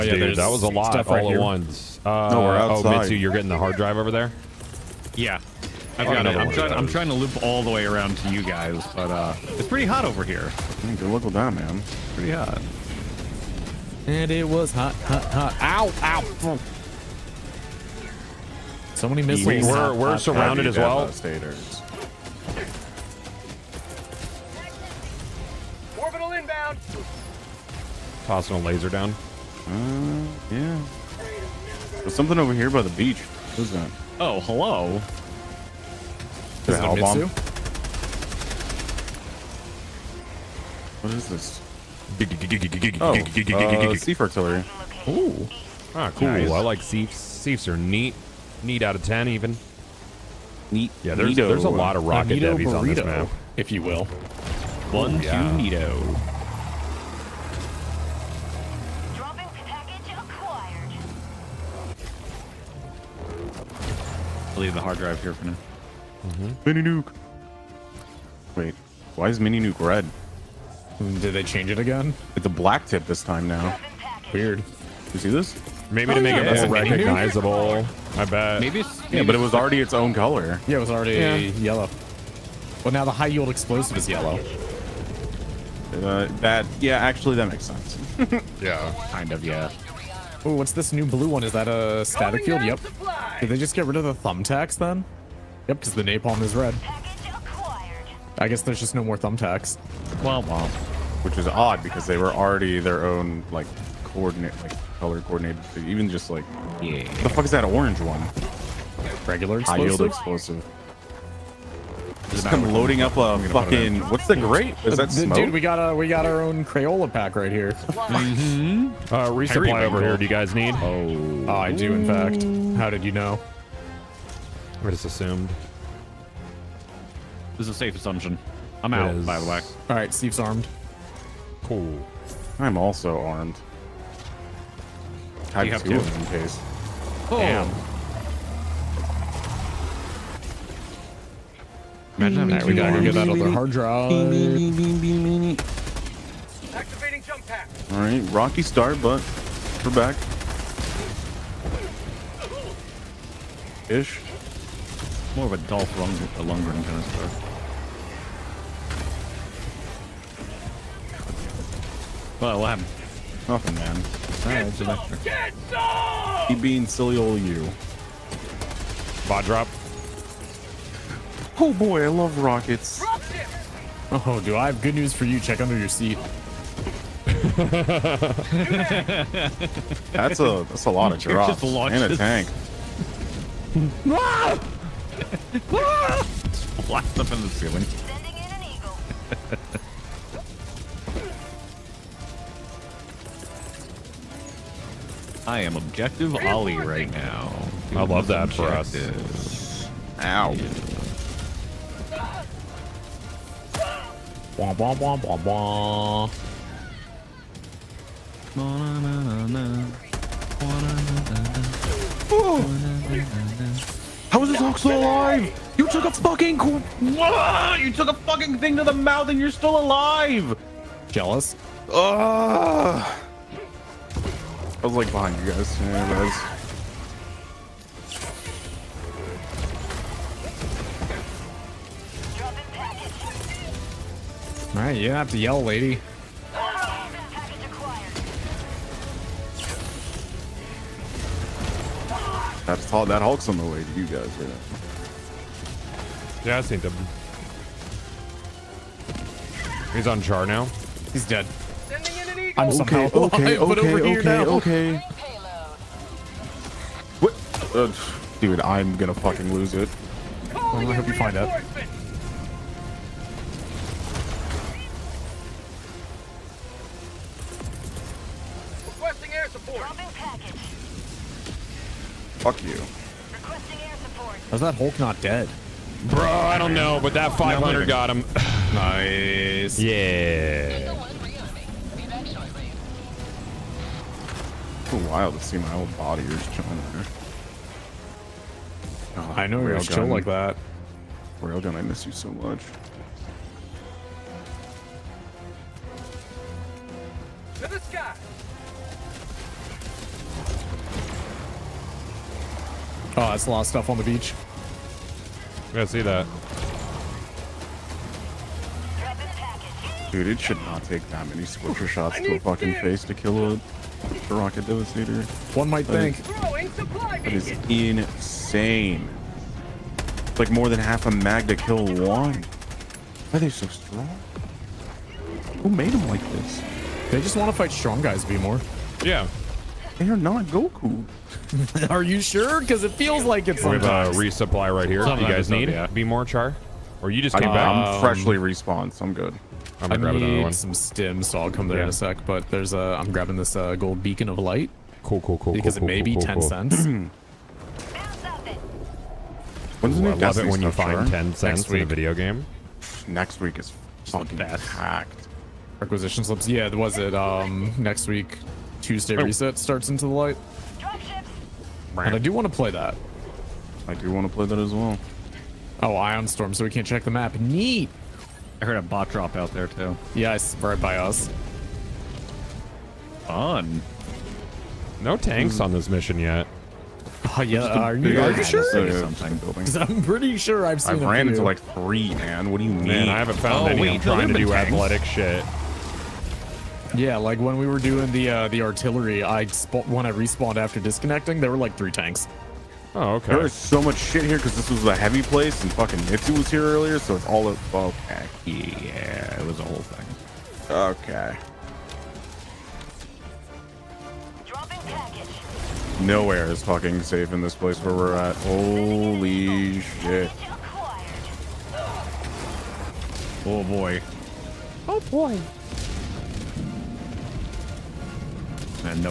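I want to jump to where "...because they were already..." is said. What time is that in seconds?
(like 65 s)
101 s.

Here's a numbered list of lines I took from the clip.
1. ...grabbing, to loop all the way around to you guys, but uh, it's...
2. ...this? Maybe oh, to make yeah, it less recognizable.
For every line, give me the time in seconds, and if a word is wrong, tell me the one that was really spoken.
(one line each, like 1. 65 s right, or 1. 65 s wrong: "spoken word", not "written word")
1. 6 s wrong: "trying", not "grabbing"
2. 75 s right.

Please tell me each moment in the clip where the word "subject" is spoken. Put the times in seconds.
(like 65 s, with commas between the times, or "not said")
not said.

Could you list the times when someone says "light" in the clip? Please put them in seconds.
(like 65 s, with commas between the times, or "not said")
344 s, 360 s.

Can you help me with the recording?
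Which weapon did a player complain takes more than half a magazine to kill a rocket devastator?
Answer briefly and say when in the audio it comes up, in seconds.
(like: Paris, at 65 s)
Scorcher, at 311 s.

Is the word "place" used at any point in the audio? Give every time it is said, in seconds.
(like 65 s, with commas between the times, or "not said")
395 s, 407 s.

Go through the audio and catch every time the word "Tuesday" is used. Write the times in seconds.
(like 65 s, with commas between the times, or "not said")
358 s.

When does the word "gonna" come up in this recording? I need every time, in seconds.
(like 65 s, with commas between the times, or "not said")
258 s, 339 s.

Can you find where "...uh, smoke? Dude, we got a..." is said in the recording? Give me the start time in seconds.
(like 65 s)
115 s.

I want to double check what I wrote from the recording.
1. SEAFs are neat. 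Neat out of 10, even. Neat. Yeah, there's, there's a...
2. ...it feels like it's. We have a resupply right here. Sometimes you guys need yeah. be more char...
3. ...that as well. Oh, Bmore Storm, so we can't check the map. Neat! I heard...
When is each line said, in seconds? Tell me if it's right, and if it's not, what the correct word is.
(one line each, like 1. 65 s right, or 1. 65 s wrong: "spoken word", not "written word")
1. 47 s right
2. 332 s right
3. 364 s wrong: "Ion", not "Bmore".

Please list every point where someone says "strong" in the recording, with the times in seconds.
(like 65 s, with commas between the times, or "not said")
323 s, 327 s.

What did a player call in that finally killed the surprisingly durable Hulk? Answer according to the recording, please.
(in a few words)
500.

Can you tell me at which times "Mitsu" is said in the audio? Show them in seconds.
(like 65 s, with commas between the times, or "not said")
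2 s, 36 s, 396 s.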